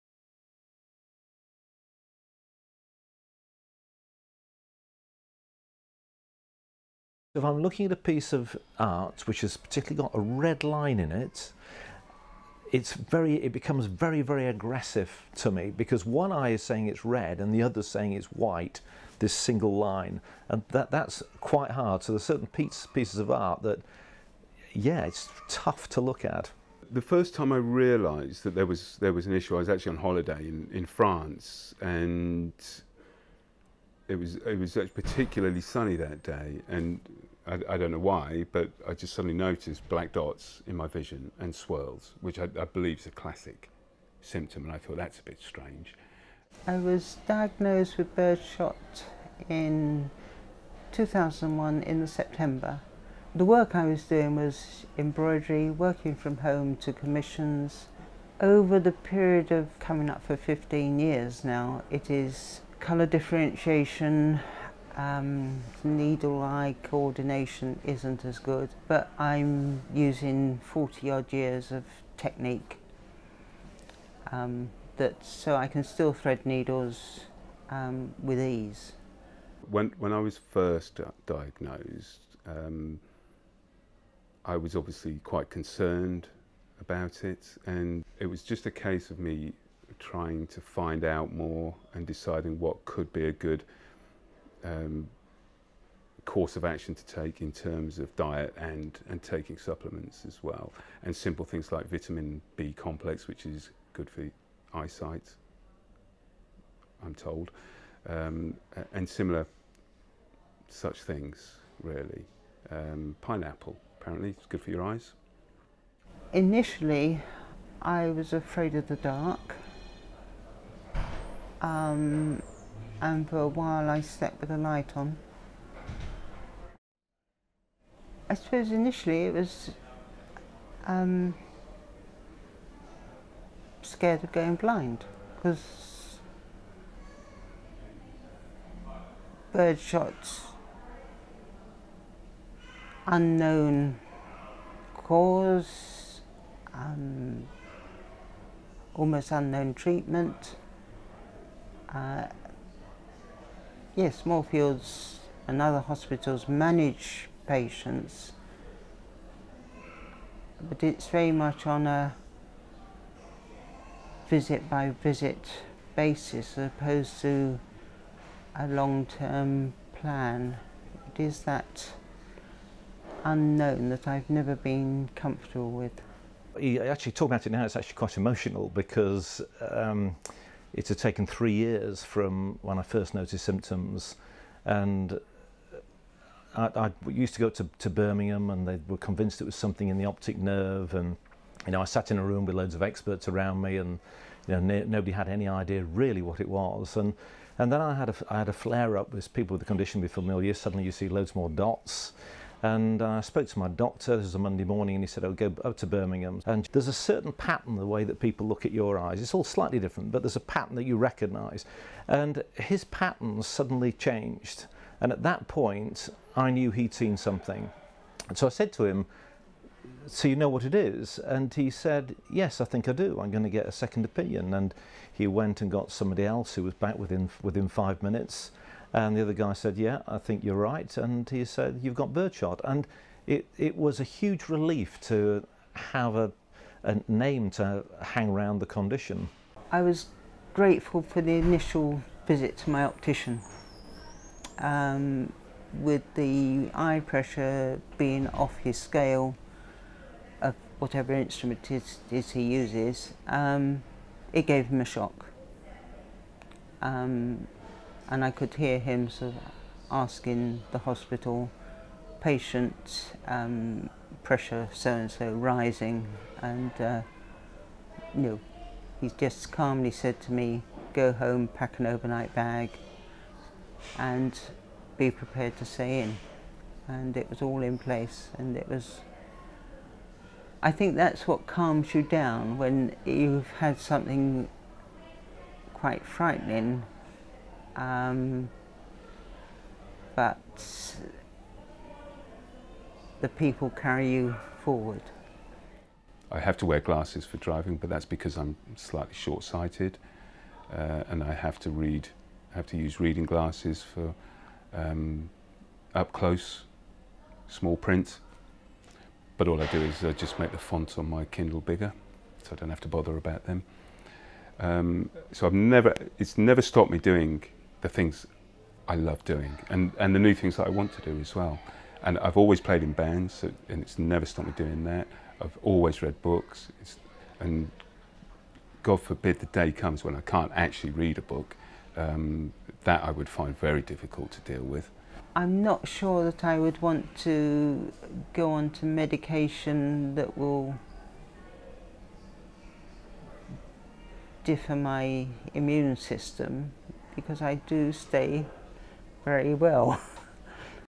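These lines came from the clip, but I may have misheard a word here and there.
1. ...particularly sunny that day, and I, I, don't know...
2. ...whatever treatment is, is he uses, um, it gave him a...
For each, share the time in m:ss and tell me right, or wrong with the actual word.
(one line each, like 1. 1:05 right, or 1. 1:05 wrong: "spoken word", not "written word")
1. 0:34 right
2. 4:10 wrong: "instrument", not "treatment".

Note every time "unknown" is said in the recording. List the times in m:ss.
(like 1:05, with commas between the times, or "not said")
2:23, 2:29, 2:53.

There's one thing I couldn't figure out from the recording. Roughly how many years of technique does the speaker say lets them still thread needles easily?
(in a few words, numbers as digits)
40.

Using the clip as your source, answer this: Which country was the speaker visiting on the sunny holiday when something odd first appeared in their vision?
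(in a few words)
France.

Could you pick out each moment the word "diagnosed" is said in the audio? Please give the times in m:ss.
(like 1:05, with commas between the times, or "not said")
0:47, 1:21.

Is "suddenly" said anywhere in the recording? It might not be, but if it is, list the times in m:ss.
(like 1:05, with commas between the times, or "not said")
0:39, 3:20, 3:33.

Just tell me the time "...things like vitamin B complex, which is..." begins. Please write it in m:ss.
1:41.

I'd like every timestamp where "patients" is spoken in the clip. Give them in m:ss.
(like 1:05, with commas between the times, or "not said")
2:37, 4:22.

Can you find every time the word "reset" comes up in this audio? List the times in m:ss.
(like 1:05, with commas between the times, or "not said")
not said.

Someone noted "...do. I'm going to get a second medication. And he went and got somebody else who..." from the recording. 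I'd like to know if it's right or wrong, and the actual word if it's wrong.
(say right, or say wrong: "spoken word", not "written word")
wrong: "opinion", not "medication".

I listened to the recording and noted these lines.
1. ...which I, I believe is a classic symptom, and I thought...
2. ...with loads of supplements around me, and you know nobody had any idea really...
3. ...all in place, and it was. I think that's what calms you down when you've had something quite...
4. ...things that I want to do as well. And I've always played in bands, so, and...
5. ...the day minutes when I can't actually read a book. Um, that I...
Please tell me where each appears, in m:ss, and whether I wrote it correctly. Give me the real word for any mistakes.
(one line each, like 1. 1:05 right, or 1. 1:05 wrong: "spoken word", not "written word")
1. 0:42 right
2. 3:12 wrong: "experts", not "supplements"
3. 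4:37 right
4. 5:20 right
5. 5:29 wrong: "comes", not "minutes".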